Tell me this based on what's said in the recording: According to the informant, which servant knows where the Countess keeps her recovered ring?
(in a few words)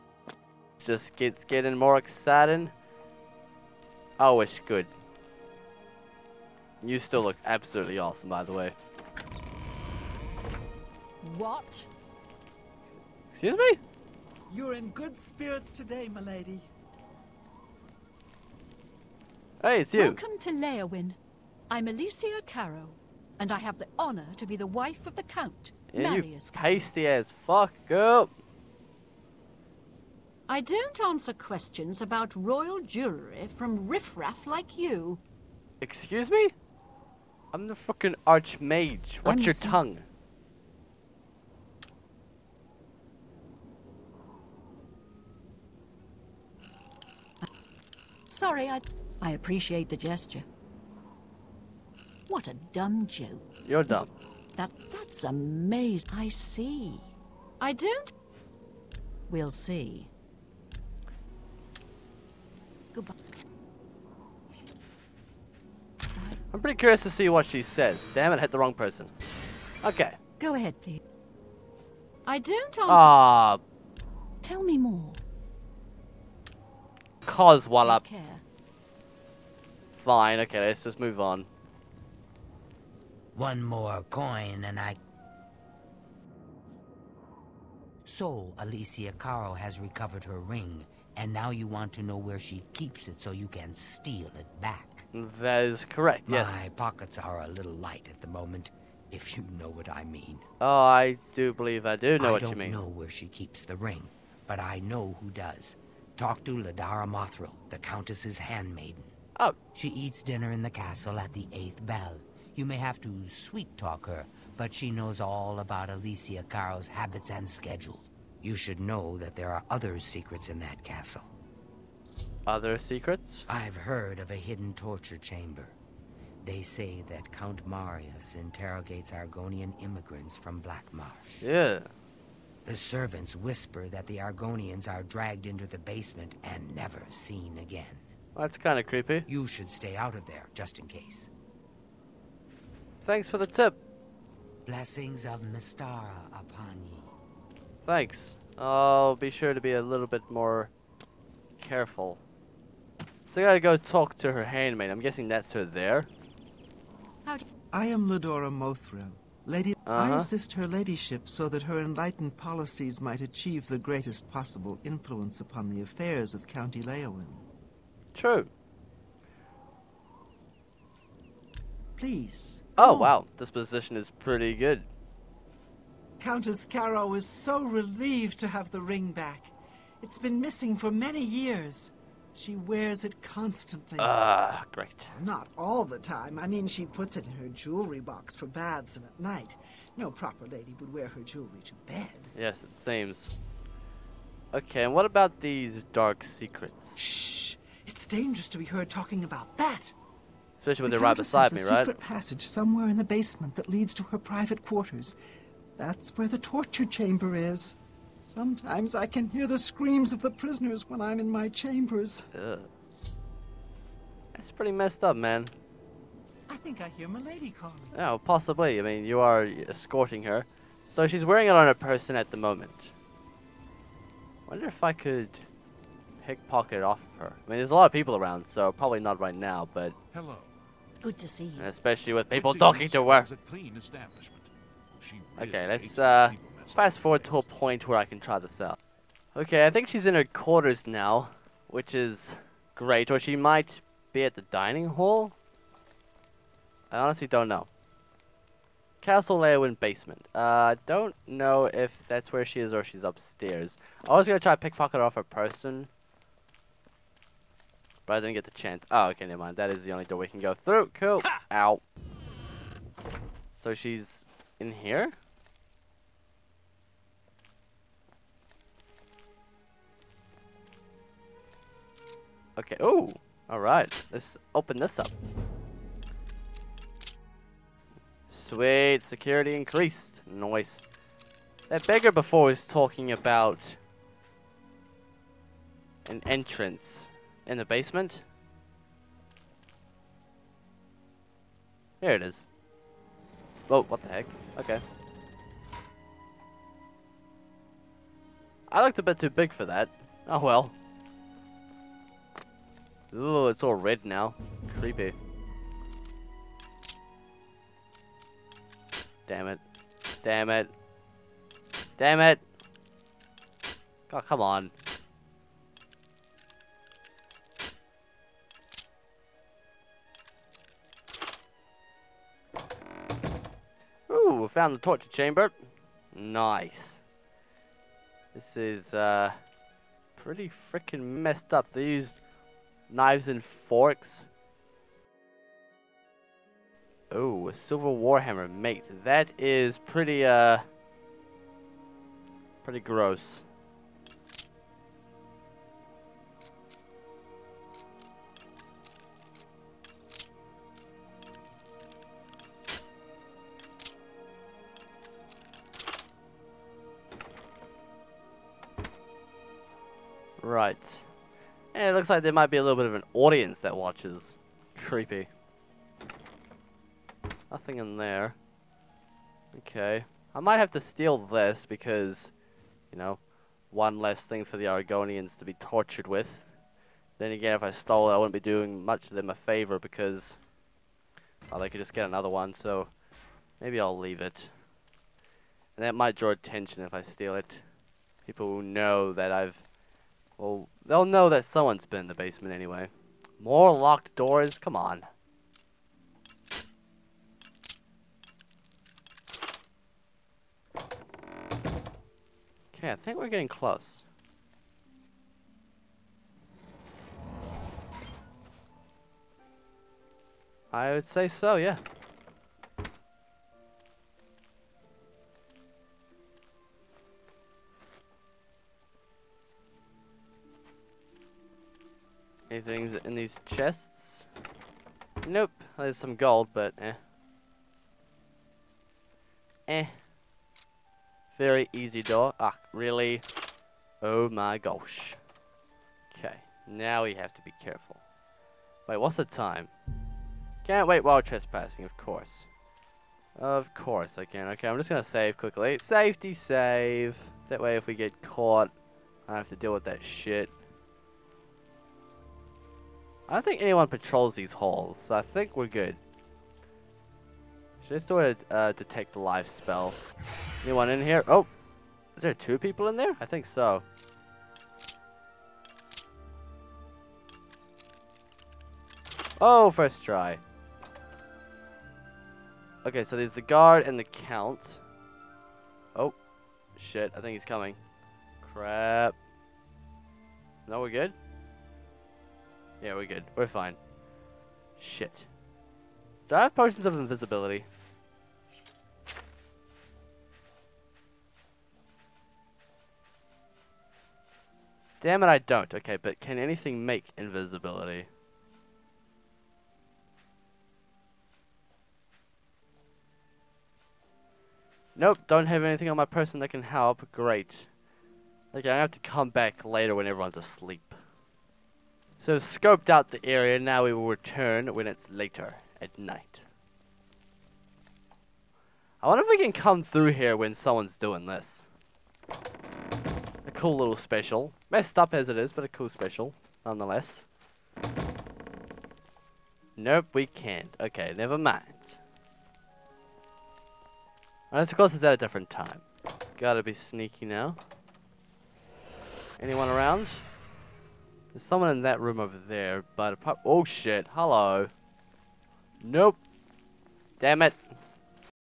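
Ladara Mothril.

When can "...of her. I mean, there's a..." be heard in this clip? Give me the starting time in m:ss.
3:47.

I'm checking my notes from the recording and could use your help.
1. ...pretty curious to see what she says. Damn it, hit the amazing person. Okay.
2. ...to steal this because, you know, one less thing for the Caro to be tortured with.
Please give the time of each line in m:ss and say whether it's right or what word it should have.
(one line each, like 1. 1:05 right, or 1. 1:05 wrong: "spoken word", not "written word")
1. 1:06 wrong: "wrong", not "amazing"
2. 6:10 wrong: "Argonians", not "Caro".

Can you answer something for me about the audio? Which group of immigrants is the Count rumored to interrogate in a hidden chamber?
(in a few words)
Argonian immigrants.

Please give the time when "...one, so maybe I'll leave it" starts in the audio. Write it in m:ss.
6:22.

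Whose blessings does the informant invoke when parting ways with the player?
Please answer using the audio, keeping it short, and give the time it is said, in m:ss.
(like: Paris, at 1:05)
Mistara, at 2:25.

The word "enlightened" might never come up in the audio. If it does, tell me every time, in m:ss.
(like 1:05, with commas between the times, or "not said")
2:41.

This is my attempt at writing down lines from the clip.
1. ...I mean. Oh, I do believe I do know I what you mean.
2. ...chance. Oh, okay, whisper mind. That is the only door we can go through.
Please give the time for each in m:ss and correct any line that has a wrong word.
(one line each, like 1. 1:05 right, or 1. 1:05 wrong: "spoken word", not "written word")
1. 1:39 right
2. 4:18 wrong: "never", not "whisper".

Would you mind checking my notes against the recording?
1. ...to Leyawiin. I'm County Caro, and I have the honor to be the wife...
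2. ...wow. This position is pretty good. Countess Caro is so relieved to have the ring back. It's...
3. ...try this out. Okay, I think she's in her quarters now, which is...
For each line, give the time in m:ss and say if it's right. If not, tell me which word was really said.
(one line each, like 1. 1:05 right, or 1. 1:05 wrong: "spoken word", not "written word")
1. 0:20 wrong: "Alessia", not "County"
2. 2:52 right
3. 3:58 right.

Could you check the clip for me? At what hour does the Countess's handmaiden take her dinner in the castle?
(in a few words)
The eighth bell.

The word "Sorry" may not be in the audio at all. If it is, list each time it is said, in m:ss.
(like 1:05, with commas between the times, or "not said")
0:48.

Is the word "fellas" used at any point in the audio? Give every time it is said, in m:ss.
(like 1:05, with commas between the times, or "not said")
not said.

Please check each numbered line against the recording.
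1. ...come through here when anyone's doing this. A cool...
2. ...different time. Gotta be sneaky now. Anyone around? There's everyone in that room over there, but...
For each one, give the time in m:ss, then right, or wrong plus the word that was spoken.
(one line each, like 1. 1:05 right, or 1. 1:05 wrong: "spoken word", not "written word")
1. 8:39 wrong: "someone", not "anyone"
2. 8:55 wrong: "someone", not "everyone".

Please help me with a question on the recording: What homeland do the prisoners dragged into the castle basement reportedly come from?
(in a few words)
Black Marsh.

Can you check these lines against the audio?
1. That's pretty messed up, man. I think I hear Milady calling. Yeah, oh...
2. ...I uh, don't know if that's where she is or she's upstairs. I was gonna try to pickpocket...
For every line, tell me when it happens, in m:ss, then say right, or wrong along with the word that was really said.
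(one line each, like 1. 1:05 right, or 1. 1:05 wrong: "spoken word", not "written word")
1. 3:34 right
2. 4:10 right.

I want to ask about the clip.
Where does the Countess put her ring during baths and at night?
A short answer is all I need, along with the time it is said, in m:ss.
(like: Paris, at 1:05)
Her jewelry box, at 3:07.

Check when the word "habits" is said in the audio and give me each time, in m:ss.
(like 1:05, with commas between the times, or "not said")
1:56.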